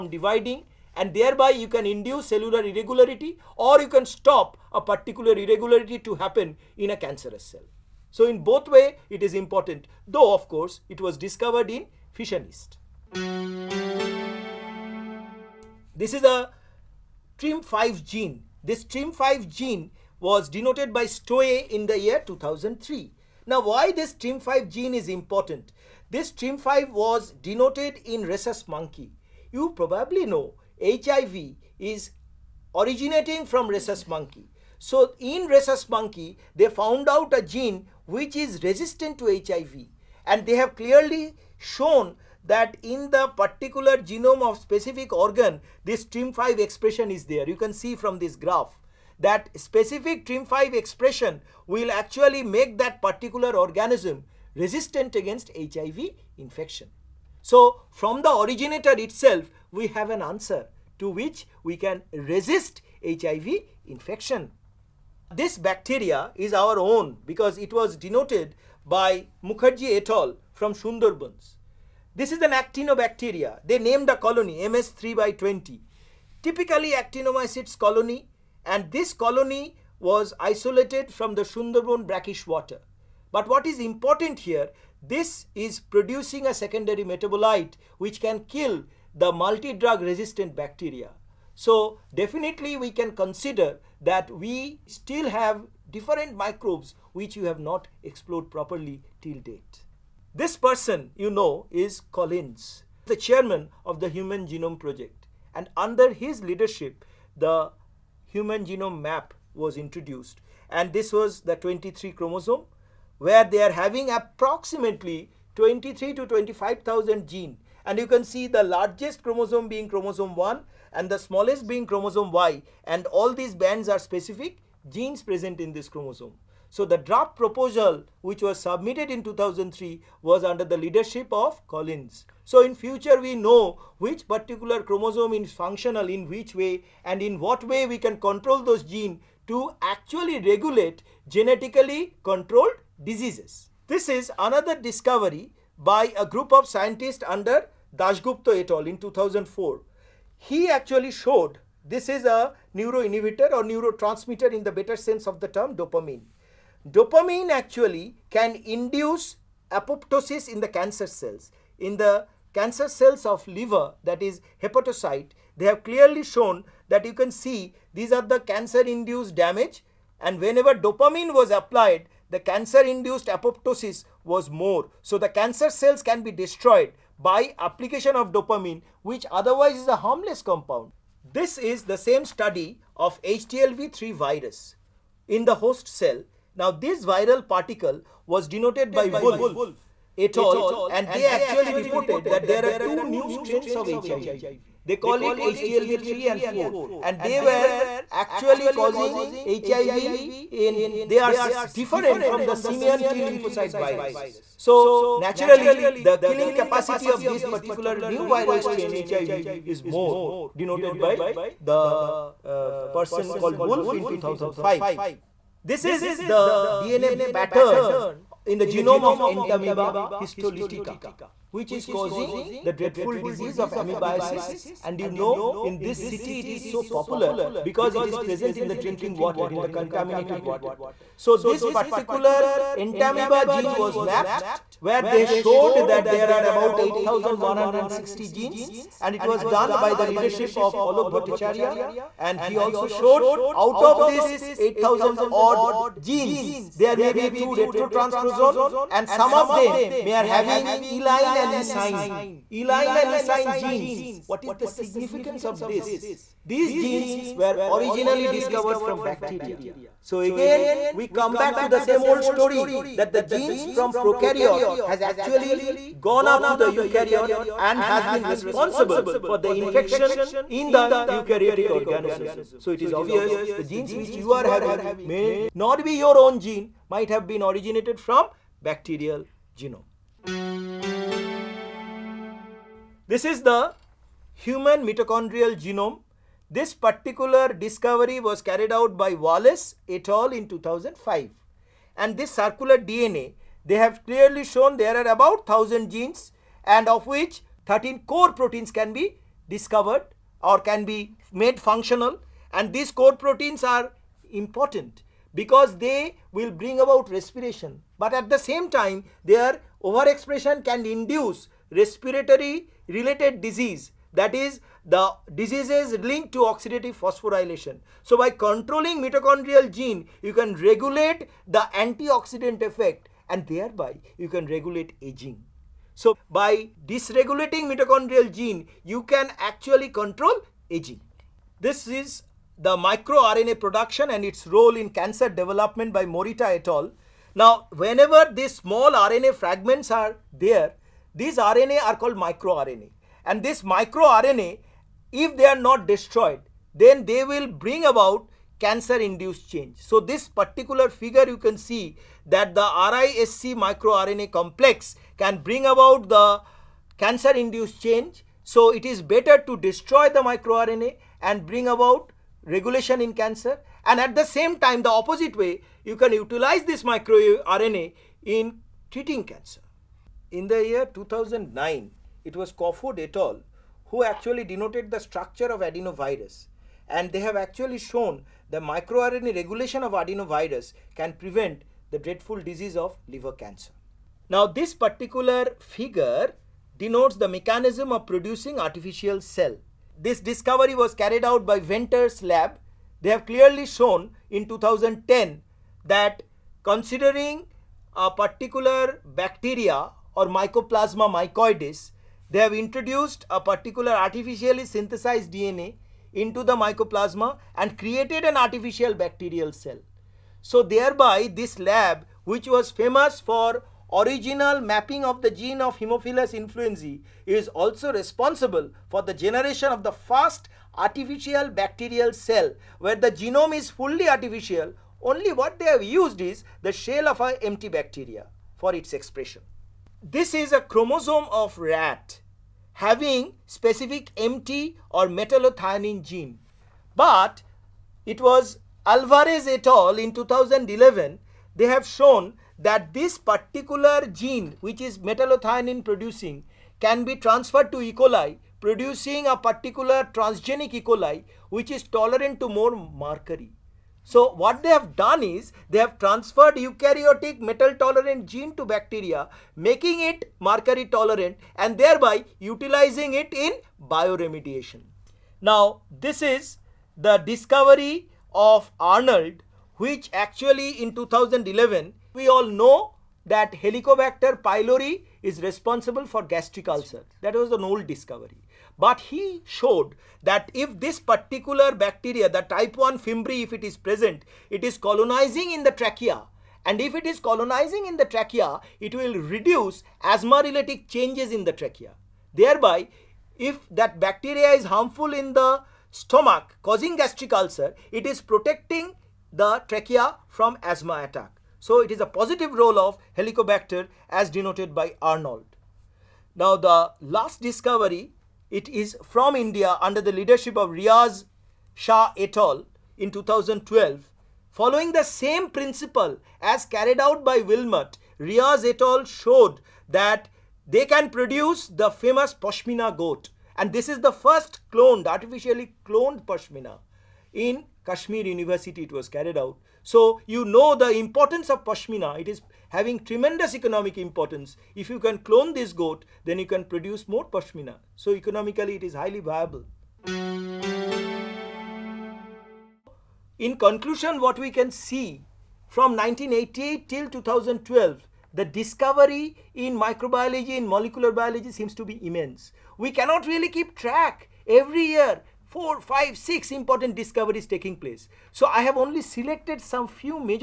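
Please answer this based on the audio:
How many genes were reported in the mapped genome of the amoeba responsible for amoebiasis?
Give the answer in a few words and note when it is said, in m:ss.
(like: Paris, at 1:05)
8160, at 3:56.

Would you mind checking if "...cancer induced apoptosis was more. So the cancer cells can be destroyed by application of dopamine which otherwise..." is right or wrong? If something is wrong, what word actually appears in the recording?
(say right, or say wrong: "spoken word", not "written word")
right.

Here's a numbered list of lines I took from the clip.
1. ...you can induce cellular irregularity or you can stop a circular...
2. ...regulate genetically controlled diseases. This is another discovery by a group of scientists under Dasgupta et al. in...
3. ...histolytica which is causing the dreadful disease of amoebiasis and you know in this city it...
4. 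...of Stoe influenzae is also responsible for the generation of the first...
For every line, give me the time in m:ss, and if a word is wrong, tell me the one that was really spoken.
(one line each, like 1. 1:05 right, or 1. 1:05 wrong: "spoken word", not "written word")
1. 0:01 wrong: "particular", not "circular"
2. 2:20 right
3. 3:40 right
4. 6:55 wrong: "Haemophilus", not "Stoe".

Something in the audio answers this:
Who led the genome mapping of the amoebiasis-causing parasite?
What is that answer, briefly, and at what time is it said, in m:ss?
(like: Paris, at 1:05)
Alok Bhattacharya, at 4:00.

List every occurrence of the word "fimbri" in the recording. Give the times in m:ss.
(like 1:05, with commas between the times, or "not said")
8:02.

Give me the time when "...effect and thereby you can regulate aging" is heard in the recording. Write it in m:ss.
5:22.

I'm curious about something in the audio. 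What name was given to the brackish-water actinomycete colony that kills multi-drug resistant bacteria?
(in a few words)
MS3 by 20.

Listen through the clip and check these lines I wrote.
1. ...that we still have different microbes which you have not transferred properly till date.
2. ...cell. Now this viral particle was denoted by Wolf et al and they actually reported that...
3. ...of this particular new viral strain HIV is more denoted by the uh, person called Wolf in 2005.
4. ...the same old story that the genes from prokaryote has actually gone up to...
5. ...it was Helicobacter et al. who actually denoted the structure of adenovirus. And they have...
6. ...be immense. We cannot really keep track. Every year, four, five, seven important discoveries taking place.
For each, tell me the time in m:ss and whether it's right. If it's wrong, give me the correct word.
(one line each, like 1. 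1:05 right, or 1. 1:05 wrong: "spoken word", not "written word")
1. 1:34 wrong: "explored", not "transferred"
2. 3:05 right
3. 3:27 right
4. 4:21 right
5. 6:12 wrong: "Cofod", not "Helicobacter"
6. 9:11 wrong: "six", not "seven".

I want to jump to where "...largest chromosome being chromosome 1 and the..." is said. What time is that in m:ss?
1:58.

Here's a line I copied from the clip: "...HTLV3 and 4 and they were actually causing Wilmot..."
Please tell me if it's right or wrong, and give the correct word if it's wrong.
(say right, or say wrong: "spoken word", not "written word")
wrong: "HIV", not "Wilmot".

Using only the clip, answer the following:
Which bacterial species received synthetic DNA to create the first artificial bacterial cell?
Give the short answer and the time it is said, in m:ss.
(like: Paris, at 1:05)
Mycoplasma mycoides, at 6:40.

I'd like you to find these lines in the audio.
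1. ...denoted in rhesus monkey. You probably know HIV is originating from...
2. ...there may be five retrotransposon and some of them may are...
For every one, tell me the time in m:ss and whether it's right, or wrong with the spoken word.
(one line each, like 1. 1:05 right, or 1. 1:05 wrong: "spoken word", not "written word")
1. 0:27 right
2. 4:06 wrong: "two", not "five".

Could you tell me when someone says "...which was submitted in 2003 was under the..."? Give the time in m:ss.
2:08.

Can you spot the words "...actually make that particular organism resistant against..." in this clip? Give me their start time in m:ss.
0:51.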